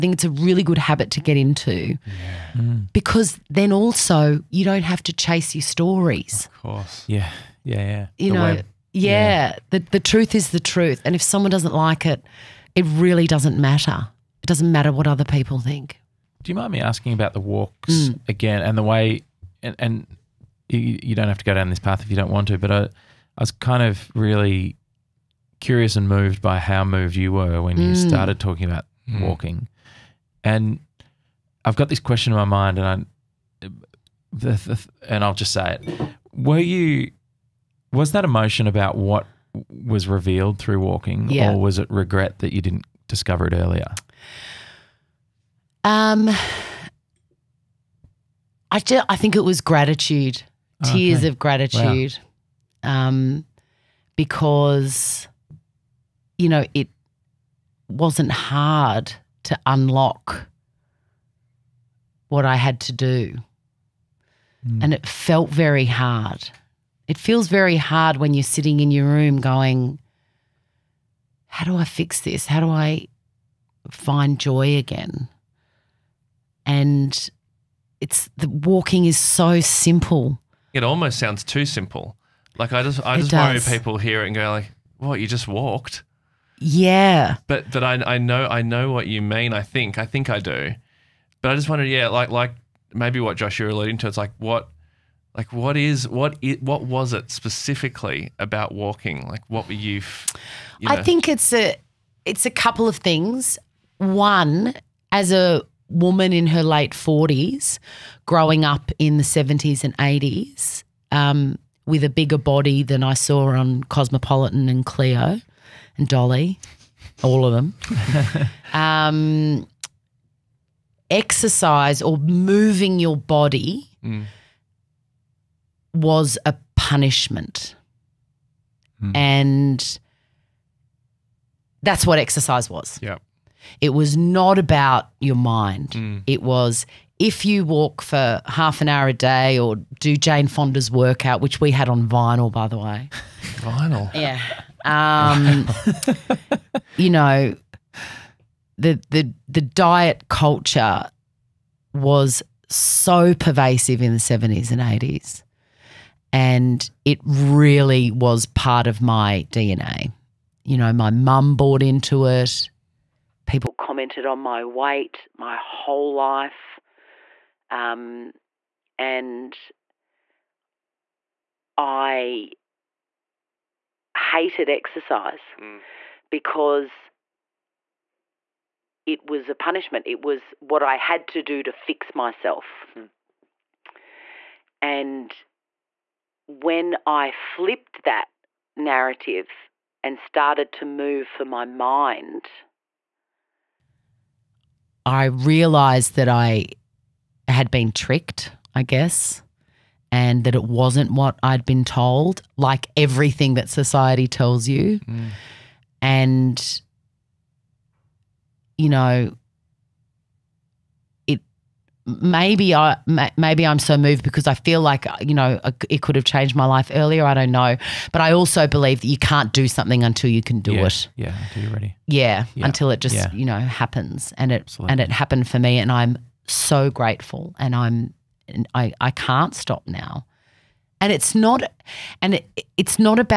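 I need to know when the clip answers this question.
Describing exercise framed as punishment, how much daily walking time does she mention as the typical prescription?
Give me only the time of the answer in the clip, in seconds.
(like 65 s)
138 s.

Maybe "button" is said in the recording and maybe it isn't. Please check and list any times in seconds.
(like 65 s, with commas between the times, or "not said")
not said.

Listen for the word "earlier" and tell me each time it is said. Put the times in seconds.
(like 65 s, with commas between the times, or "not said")
43 s, 216 s.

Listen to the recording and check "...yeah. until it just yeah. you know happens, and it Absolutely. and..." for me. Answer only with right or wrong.
right.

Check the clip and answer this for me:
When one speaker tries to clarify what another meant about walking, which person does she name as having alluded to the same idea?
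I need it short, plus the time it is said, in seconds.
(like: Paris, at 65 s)
Josh, at 93 s.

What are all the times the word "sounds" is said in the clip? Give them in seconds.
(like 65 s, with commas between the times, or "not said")
81 s.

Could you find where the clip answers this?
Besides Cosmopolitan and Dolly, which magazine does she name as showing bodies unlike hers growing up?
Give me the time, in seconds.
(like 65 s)
114 s.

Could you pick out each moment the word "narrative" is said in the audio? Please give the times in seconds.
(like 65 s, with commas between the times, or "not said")
188 s.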